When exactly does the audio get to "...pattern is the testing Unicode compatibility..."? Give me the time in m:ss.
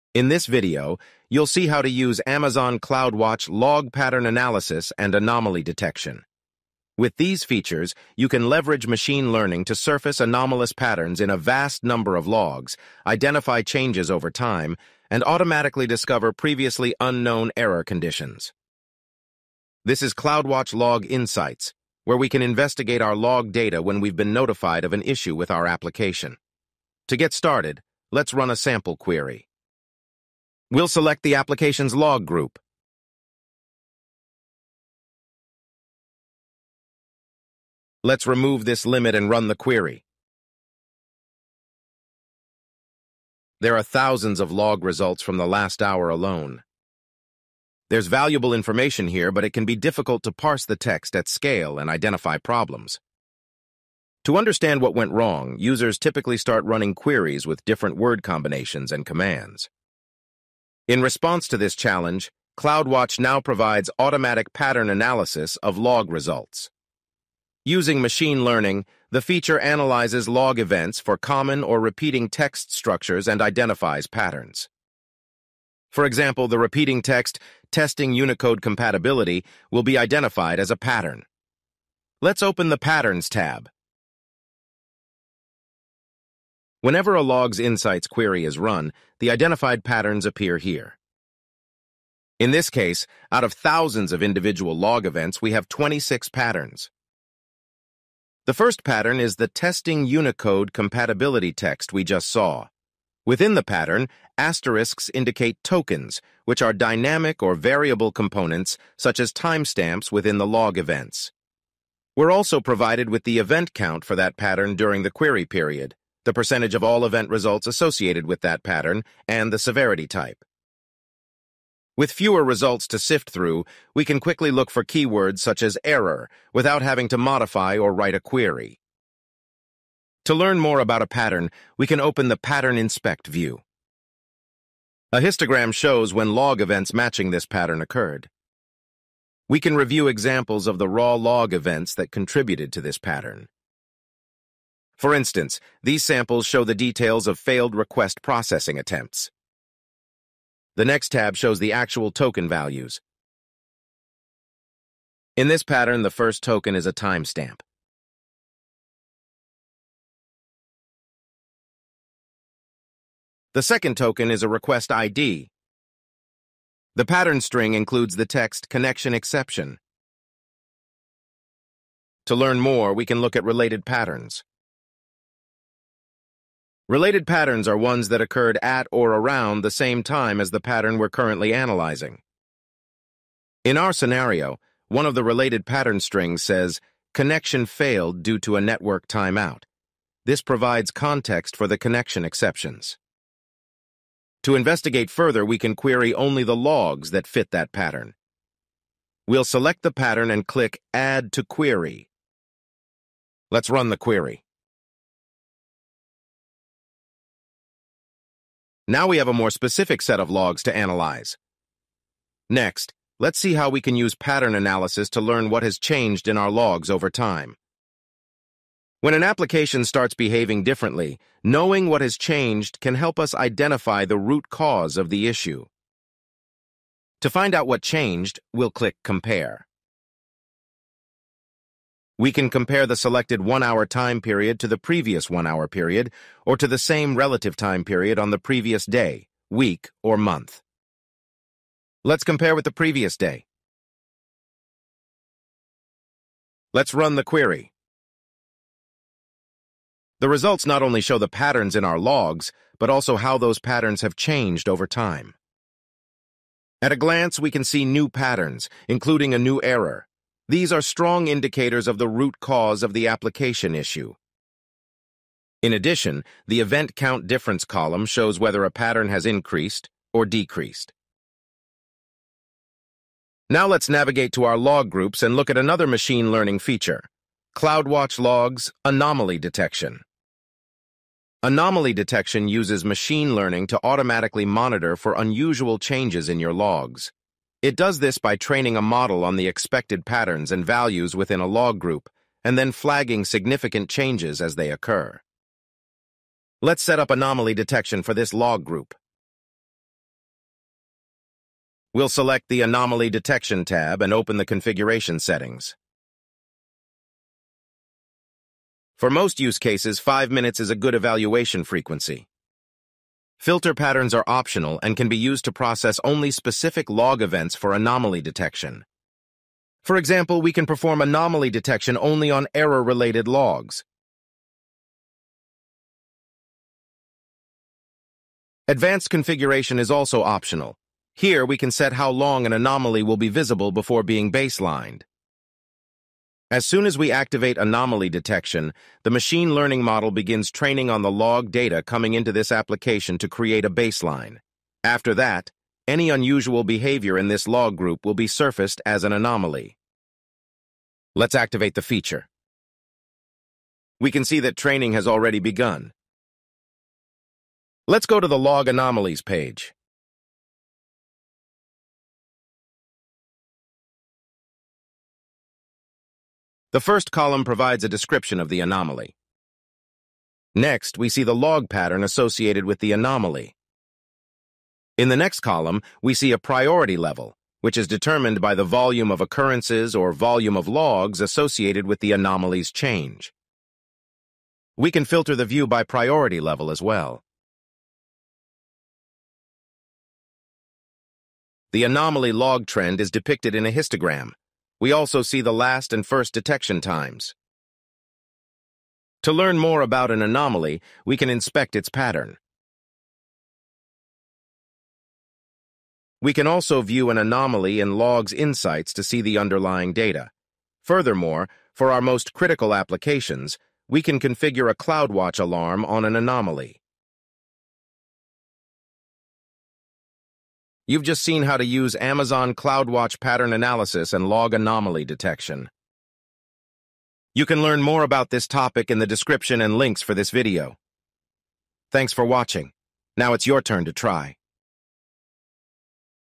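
1:38.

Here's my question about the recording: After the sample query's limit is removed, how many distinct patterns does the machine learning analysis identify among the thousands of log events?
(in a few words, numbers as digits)
26.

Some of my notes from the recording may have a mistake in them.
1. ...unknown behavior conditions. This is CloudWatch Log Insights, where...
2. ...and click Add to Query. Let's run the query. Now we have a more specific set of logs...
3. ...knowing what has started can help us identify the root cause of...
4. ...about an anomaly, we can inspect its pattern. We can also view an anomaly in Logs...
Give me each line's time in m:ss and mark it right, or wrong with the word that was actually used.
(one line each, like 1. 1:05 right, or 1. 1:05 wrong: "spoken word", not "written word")
1. 0:16 wrong: "error", not "behavior"
2. 3:20 right
3. 3:41 wrong: "changed", not "started"
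4. 6:39 right.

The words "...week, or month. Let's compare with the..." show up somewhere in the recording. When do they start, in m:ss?
3:59.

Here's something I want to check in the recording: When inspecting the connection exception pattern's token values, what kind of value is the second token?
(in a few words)
Request ID.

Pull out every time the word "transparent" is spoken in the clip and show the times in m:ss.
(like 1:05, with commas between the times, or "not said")
not said.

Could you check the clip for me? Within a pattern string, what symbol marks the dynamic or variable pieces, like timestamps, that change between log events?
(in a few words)
Asterisks.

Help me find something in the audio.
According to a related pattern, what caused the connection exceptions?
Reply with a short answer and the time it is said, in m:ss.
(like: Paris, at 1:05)
Network timeout, at 3:08.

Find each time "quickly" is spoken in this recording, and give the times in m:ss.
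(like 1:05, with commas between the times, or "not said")
2:04.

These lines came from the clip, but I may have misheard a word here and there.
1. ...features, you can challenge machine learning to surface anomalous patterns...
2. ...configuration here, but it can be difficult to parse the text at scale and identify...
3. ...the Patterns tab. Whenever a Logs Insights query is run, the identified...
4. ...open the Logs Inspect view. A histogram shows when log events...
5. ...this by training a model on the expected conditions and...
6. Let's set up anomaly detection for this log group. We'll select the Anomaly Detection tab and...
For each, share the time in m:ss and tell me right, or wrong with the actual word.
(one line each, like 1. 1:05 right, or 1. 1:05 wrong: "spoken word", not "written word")
1. 0:07 wrong: "leverage", not "challenge"
2. 0:48 wrong: "information", not "configuration"
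3. 1:22 right
4. 2:11 wrong: "Pattern", not "Logs"
5. 4:47 wrong: "patterns", not "conditions"
6. 4:56 right.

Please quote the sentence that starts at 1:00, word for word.
In response to this challenge, CloudWatch now provides automatic pattern analysis of log results.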